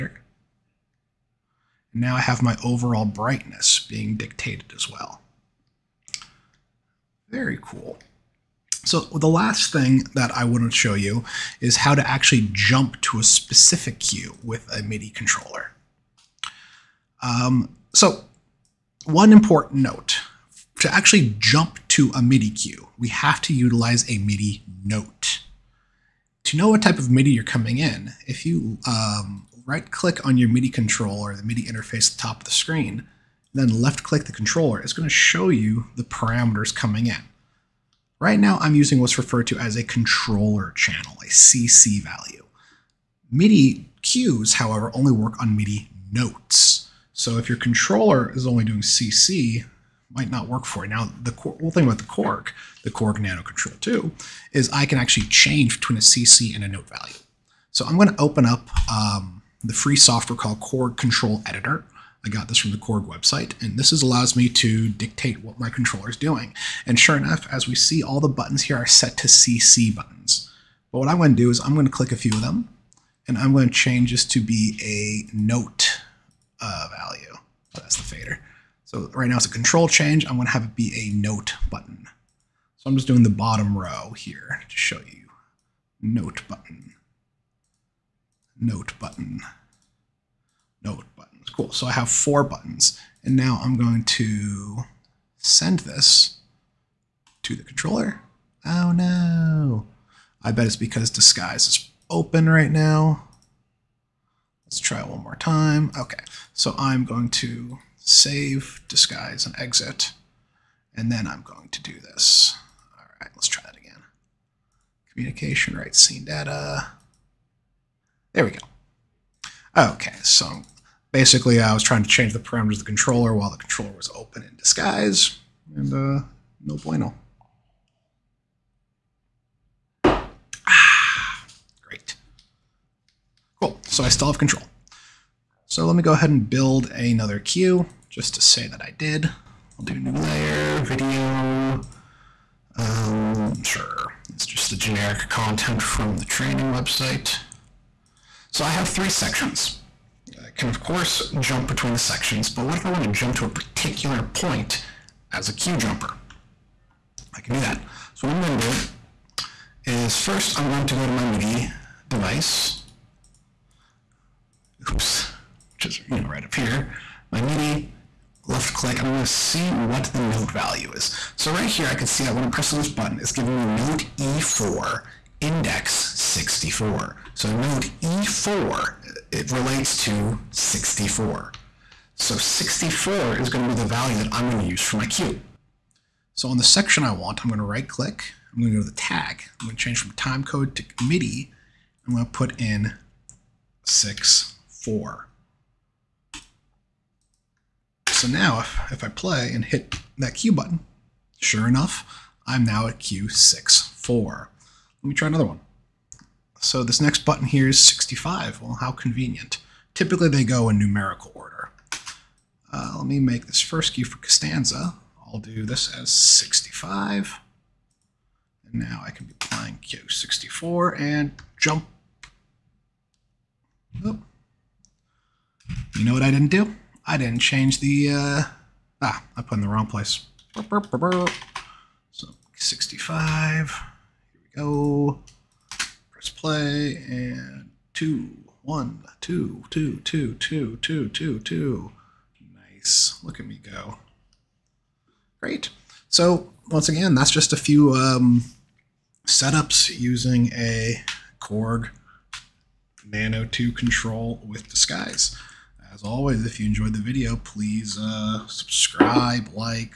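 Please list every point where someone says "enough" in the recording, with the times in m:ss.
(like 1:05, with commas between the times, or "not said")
1:07, 3:21.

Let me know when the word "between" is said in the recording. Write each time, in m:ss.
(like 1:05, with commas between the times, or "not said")
0:55, 2:31.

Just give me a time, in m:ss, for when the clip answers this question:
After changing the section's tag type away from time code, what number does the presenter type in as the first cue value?
3:13.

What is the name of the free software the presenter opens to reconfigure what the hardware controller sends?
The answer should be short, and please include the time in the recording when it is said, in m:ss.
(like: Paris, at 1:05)
Korg Kontrol Editor, at 1:00.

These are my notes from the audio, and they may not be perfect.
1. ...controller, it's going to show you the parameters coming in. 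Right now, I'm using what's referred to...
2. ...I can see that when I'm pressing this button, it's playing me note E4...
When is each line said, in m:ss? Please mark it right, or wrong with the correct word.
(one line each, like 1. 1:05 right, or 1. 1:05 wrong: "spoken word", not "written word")
1. 0:34 right
2. 2:51 wrong: "giving", not "playing".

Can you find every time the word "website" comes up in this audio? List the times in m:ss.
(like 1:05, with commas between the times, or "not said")
1:03, 2:26.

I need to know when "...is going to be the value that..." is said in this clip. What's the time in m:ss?
3:03.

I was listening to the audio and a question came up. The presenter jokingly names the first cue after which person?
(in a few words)
Costanza.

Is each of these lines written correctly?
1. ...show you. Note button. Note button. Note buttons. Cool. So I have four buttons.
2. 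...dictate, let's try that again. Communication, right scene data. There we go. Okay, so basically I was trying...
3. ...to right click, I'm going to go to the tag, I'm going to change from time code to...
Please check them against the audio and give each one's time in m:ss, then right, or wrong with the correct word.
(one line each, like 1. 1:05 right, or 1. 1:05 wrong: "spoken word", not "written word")
1. 1:24 right
2. 1:53 wrong: "write", not "dictate"
3. 3:07 right.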